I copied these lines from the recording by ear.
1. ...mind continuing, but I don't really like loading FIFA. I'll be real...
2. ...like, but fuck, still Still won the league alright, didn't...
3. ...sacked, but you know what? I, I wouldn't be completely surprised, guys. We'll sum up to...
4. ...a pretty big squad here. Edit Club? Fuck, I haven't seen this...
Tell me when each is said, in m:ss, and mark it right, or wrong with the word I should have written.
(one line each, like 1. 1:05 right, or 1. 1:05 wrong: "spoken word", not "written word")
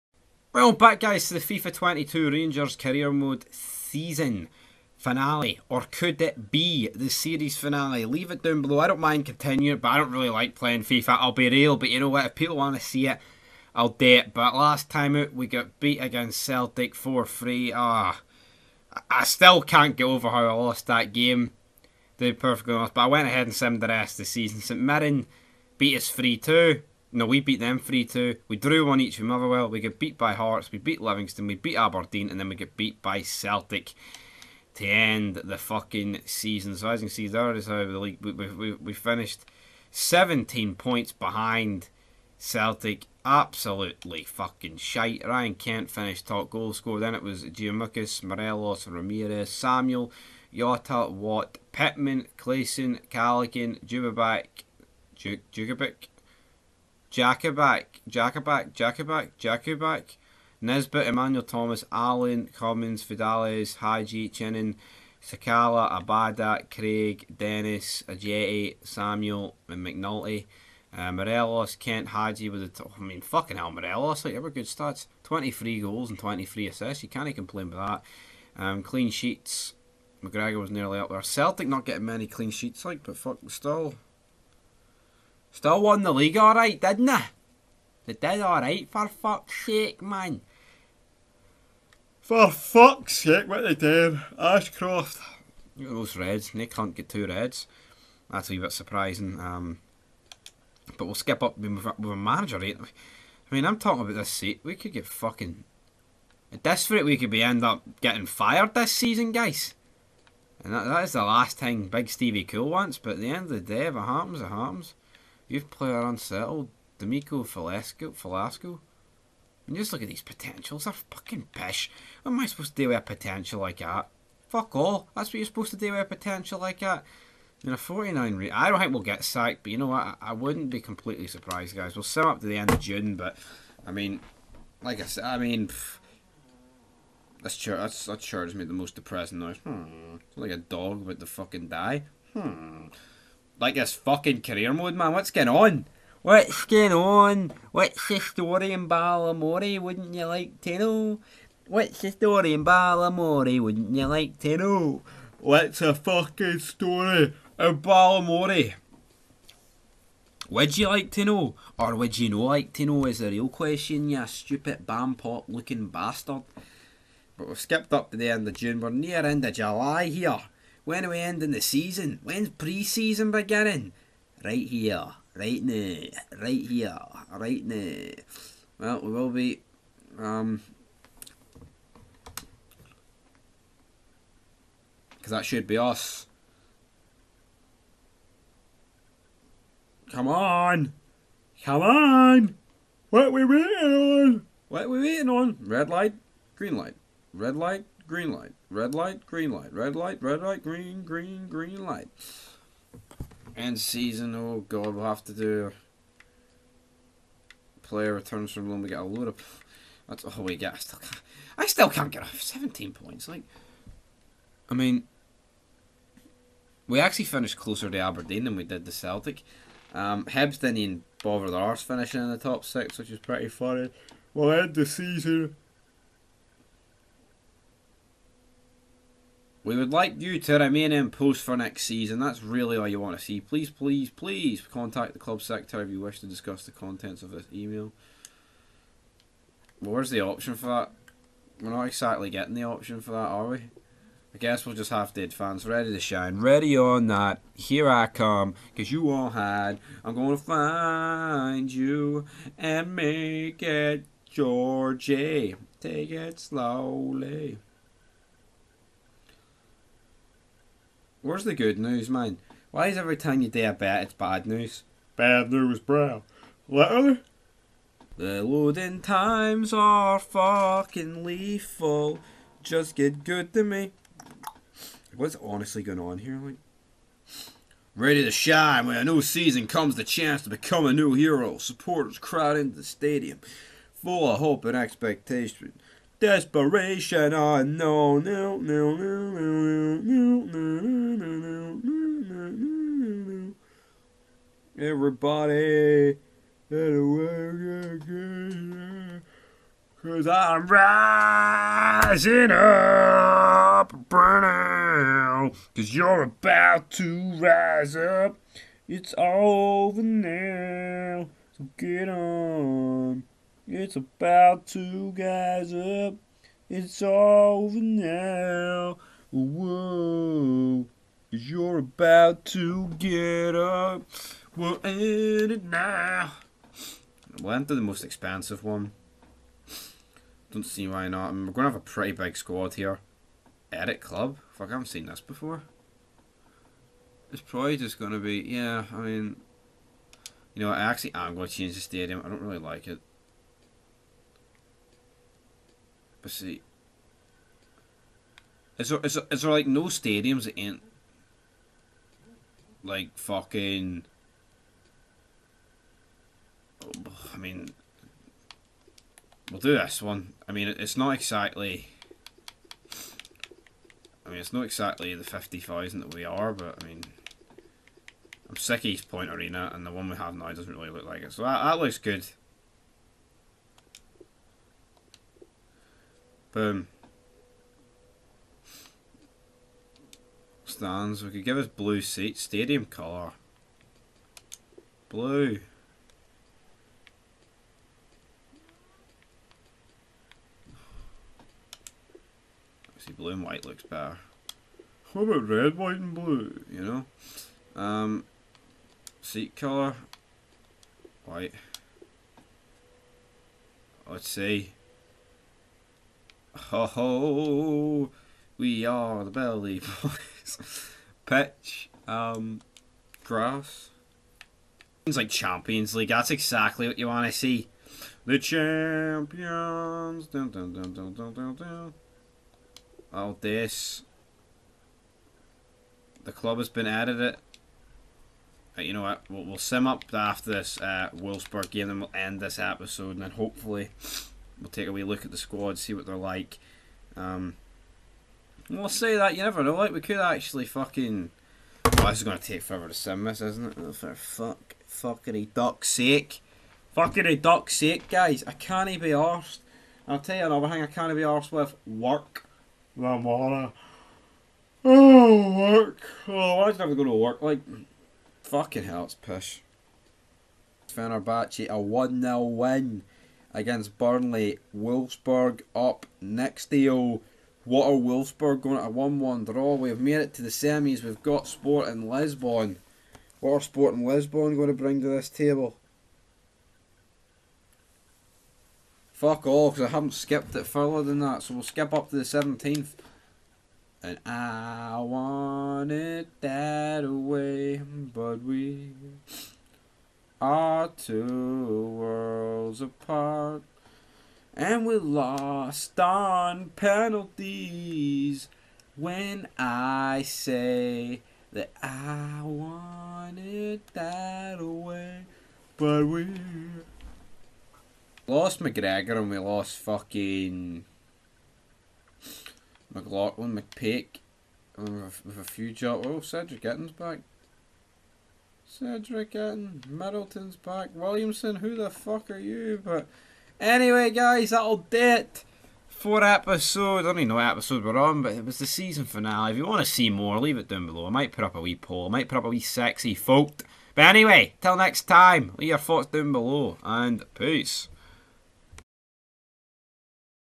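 1. 0:08 wrong: "playing", not "loading"
2. 1:22 right
3. 2:09 right
4. 5:31 right.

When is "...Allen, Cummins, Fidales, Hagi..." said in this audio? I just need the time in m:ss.
1:01.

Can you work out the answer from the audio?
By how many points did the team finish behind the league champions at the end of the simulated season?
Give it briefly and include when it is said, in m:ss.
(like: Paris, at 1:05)
17, at 0:39.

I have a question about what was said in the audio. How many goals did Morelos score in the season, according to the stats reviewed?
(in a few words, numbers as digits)
23.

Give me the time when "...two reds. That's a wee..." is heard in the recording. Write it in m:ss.
1:37.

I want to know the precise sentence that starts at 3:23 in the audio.
End season, oh god, we'll have to do player returns from loan, we get a load of that's all we get.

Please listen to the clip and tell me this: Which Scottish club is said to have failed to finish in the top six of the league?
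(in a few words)
Hibs.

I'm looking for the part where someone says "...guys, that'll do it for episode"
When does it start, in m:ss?
8:44.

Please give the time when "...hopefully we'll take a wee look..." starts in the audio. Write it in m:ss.
7:13.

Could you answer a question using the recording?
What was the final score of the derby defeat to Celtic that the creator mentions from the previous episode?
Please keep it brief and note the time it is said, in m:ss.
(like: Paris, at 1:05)
4-3, at 0:16.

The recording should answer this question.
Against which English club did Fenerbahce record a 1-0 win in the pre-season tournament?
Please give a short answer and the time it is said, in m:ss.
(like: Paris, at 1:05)
Burnley, at 7:43.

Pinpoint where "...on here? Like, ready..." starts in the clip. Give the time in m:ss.
4:35.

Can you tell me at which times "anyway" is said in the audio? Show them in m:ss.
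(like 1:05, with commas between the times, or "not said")
8:43, 8:54.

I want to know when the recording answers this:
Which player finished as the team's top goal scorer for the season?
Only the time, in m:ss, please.
0:45.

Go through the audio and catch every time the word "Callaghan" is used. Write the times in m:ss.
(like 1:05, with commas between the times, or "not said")
0:53.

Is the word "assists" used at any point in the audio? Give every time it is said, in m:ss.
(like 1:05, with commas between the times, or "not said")
1:16.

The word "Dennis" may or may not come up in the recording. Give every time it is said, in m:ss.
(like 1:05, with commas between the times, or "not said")
1:07.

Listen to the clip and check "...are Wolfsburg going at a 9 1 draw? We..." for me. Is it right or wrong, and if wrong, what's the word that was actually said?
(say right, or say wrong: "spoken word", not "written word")
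wrong: "1", not "9".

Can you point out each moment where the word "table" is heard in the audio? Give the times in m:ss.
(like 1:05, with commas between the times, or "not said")
7:55.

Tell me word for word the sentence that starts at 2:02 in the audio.
What am I supposed to do with a potential like that?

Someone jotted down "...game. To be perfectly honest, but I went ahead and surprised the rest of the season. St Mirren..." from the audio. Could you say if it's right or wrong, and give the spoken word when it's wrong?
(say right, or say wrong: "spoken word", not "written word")
wrong: "simmed", not "surprised".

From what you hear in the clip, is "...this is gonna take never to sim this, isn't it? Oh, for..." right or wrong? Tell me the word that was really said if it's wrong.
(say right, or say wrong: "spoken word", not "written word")
wrong: "forever", not "never".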